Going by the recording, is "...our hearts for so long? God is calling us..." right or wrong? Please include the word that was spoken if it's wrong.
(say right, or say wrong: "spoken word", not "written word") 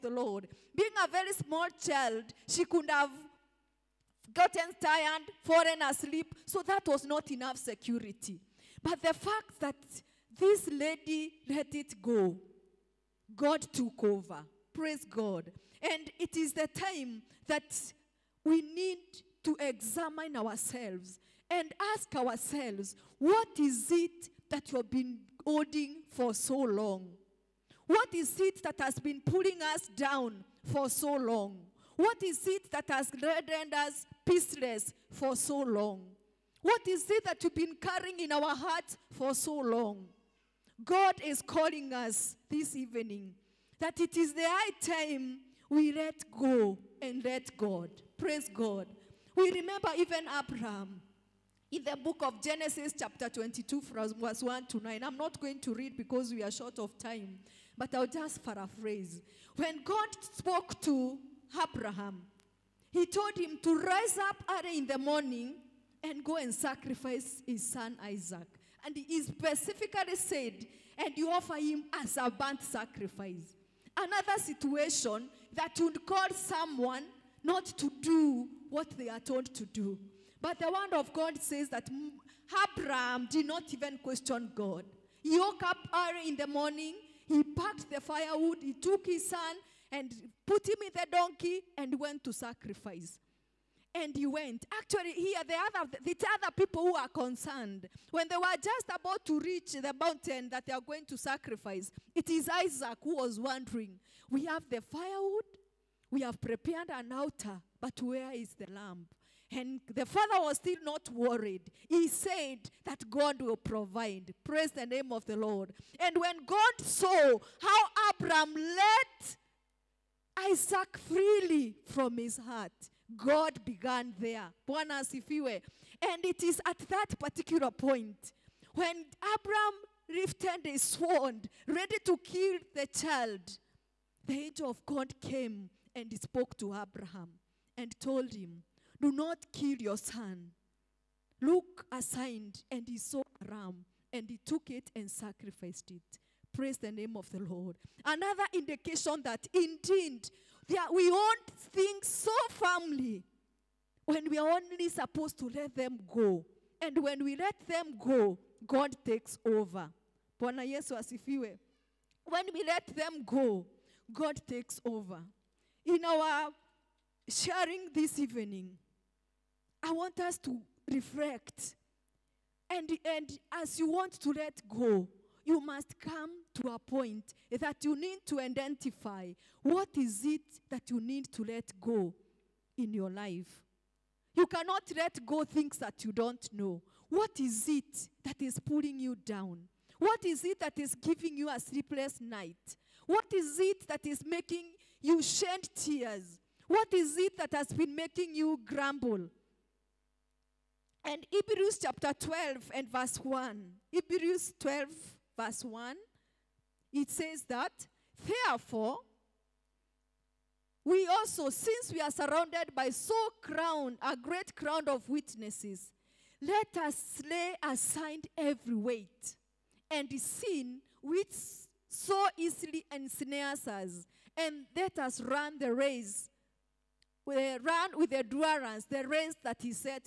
right.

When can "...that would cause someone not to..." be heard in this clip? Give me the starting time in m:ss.
1:15.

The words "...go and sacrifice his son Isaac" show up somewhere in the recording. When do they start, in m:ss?
1:06.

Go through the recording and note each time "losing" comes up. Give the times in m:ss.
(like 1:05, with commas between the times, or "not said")
not said.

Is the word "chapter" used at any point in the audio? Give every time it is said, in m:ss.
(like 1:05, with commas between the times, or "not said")
0:52, 3:21.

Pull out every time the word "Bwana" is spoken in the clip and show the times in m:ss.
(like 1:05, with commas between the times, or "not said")
2:04, 2:40.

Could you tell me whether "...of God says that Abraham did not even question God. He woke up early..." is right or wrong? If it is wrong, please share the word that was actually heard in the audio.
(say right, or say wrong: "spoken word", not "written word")
right.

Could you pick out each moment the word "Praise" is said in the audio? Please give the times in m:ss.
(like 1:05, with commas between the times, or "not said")
0:14, 0:48, 1:54, 2:26.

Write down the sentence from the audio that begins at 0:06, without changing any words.
So that was not enough security.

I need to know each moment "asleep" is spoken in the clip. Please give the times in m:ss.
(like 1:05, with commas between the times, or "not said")
0:05.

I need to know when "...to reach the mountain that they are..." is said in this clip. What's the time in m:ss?
1:39.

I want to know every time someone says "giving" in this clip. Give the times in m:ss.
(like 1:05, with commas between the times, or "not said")
3:10.